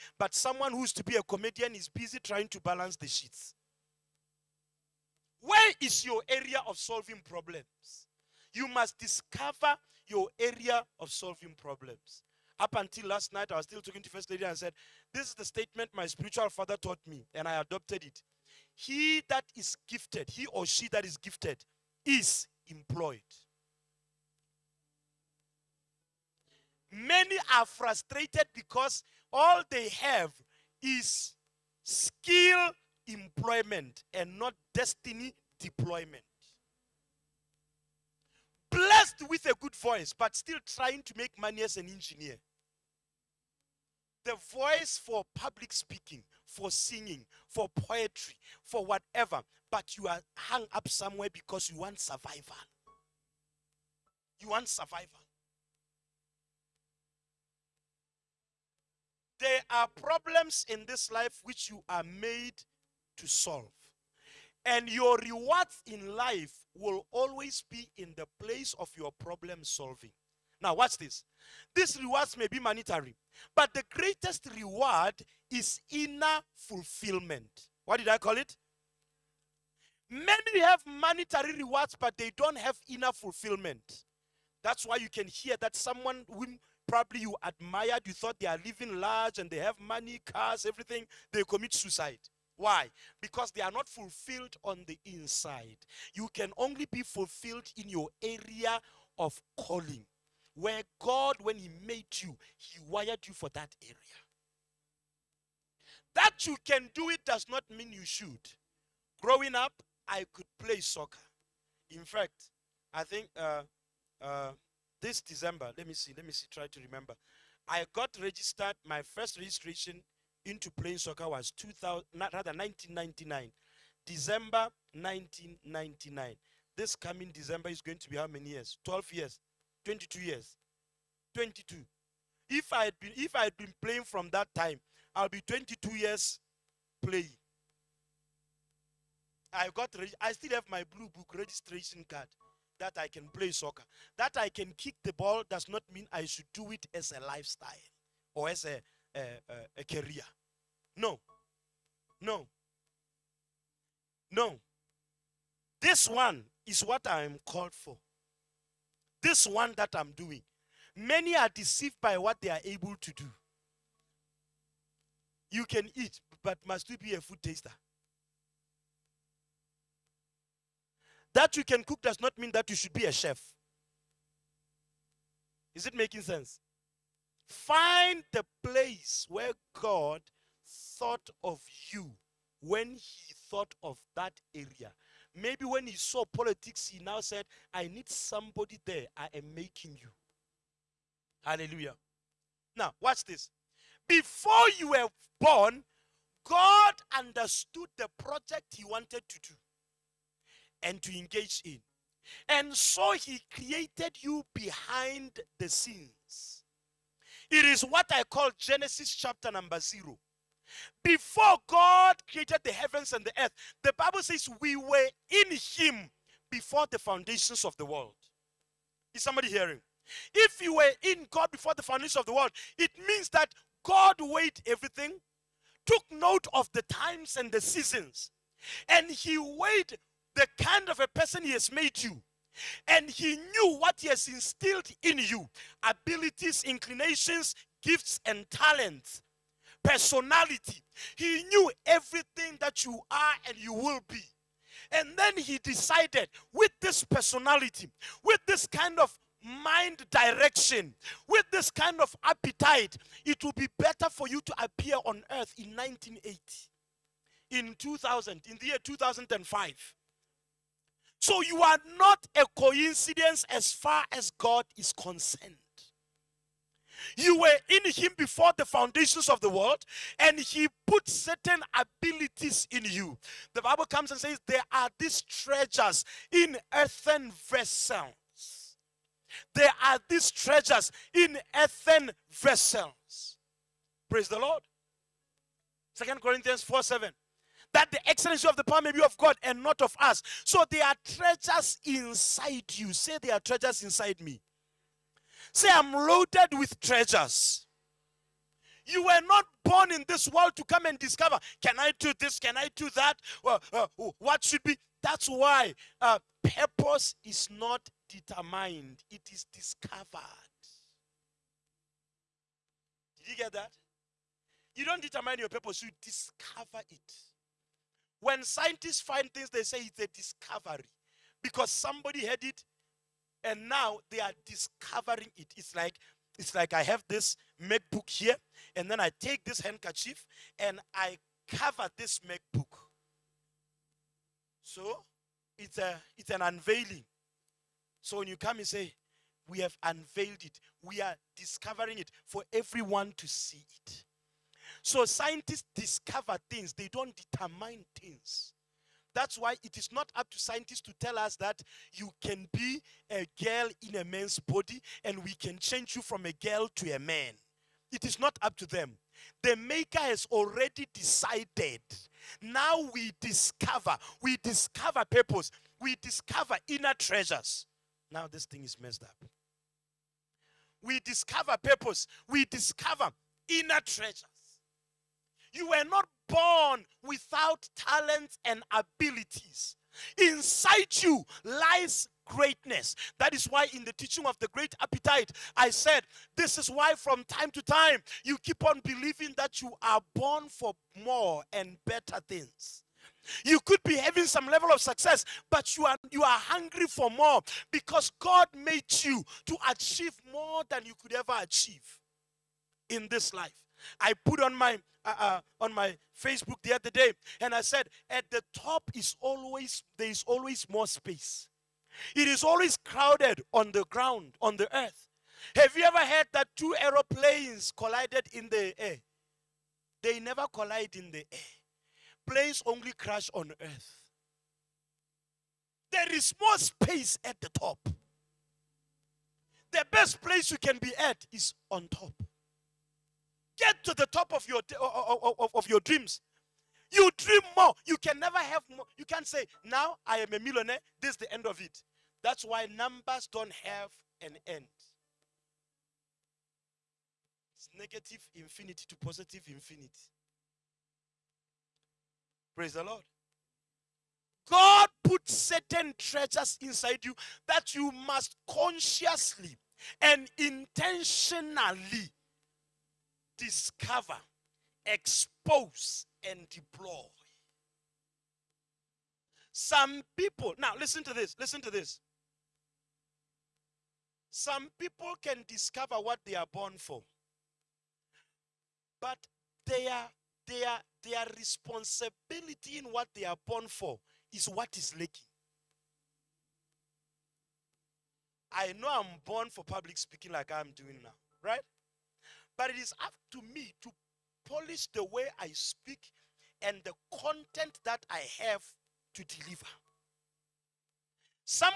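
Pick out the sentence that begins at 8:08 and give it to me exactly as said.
I know I'm born for public speaking like I'm doing now, right?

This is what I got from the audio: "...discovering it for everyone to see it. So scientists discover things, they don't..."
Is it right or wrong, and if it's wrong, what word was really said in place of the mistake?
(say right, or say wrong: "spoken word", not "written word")
right.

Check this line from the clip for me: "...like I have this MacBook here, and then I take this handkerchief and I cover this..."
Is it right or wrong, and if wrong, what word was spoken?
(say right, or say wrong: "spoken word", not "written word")
right.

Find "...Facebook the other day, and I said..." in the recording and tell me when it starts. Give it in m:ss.
6:46.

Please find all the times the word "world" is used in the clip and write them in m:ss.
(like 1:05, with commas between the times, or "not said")
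3:37, 3:42, 4:29, 5:00.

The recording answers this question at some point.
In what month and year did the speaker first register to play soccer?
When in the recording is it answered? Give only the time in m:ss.
2:04.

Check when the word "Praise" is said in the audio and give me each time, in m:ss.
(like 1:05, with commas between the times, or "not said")
4:44, 7:32.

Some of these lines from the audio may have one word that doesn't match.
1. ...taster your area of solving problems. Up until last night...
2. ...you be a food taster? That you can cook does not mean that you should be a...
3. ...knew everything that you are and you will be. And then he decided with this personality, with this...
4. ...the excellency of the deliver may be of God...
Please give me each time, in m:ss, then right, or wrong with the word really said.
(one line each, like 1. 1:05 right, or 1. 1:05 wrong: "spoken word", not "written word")
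1. 0:08 wrong: "discover", not "taster"
2. 2:46 right
3. 4:01 right
4. 4:47 wrong: "power", not "deliver".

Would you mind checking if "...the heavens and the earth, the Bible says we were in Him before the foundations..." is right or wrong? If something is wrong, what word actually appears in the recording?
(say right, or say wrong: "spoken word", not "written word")
right.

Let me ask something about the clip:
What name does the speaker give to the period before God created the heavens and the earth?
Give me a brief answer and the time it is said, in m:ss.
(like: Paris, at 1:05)
Genesis chapter 0, at 3:28.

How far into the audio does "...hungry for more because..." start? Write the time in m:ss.
6:36.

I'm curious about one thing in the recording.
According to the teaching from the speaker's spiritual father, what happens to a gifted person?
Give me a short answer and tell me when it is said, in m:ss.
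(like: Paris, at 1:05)
Employed, at 0:22.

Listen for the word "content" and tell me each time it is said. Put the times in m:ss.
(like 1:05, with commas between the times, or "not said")
8:17.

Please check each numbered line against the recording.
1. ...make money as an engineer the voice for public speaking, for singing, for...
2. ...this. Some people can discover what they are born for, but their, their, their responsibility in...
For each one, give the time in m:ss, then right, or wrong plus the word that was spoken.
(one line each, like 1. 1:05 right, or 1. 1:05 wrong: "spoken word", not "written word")
1. 0:41 right
2. 7:51 right.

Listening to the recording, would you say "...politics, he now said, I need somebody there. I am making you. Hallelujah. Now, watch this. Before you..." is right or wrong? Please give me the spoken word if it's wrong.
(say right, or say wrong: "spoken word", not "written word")
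right.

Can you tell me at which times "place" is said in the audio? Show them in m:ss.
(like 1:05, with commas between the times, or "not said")
1:08, 2:58, 7:10.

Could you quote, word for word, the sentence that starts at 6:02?
Now we discover, we discover purpose, we discover inner treasures.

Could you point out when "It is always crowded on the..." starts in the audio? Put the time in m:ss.
6:52.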